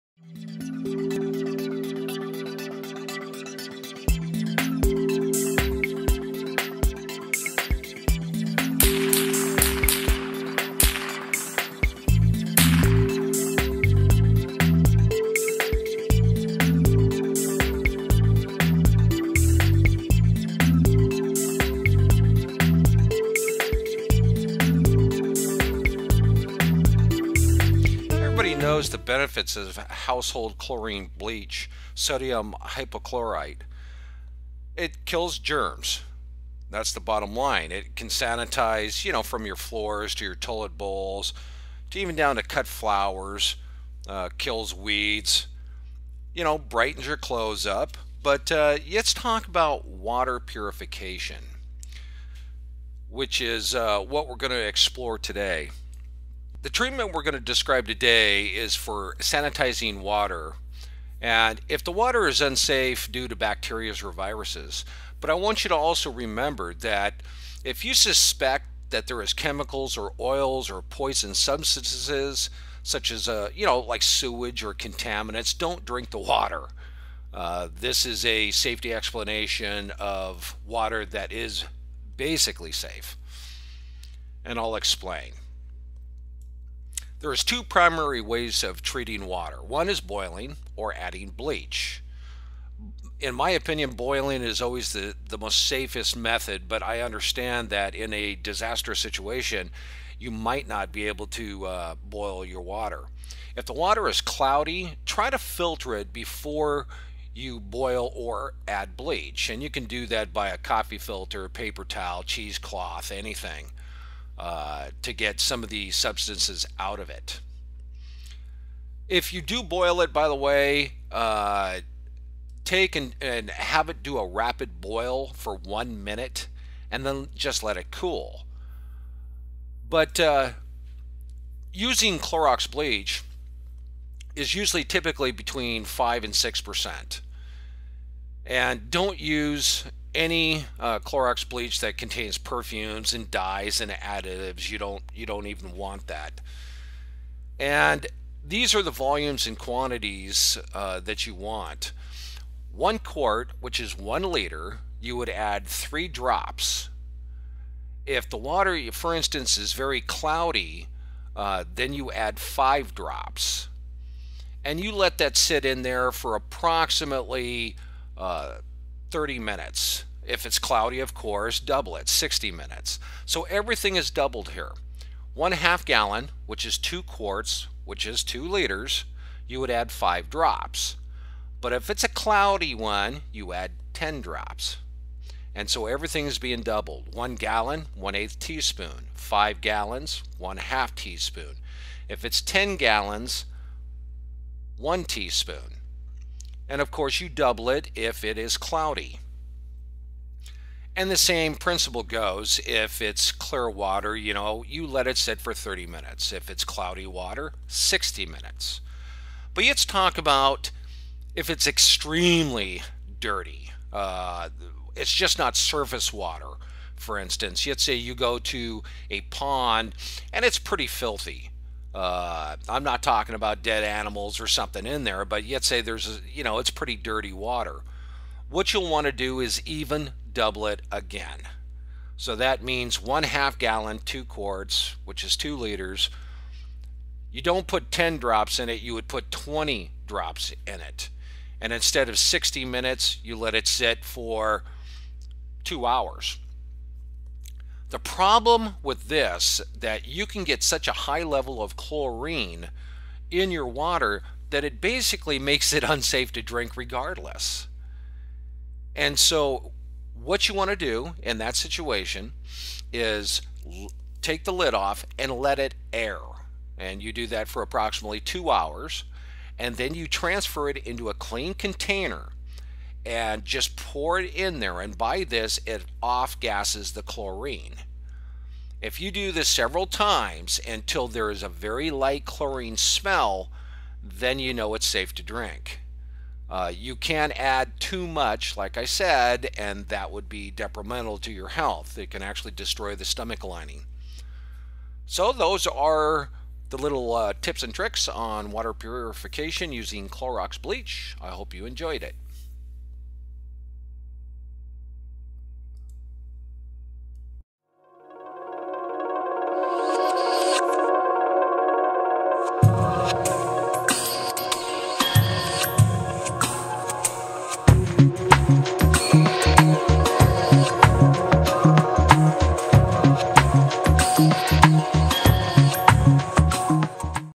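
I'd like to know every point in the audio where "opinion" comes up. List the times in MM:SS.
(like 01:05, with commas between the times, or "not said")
01:33.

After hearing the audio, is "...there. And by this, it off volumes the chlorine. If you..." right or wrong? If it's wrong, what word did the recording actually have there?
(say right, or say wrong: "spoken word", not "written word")
wrong: "gases", not "volumes".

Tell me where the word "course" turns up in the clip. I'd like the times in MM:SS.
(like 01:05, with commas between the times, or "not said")
02:51, 03:16.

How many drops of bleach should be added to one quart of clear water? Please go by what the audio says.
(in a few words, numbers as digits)
3 drops.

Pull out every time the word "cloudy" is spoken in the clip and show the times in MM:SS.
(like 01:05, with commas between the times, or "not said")
01:44, 02:40, 02:50, 03:02, 03:18, 03:26.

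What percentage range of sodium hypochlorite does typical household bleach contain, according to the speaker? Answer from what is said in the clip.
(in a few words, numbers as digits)
5 to 6 percent.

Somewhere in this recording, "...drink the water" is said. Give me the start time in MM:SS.
01:15.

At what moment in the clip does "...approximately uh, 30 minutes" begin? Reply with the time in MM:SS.
02:46.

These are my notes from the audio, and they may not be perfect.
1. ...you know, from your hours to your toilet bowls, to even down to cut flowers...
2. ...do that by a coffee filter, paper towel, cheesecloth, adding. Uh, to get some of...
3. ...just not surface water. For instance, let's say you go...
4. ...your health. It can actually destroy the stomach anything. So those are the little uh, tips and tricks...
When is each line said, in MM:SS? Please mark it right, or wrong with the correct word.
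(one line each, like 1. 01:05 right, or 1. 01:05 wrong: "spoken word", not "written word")
1. 00:39 wrong: "floors", not "hours"
2. 01:49 wrong: "anything", not "adding"
3. 03:35 right
4. 04:51 wrong: "lining", not "anything".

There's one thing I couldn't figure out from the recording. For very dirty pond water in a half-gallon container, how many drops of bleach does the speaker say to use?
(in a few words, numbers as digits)
20 drops.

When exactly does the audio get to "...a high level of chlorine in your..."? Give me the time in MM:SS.
04:10.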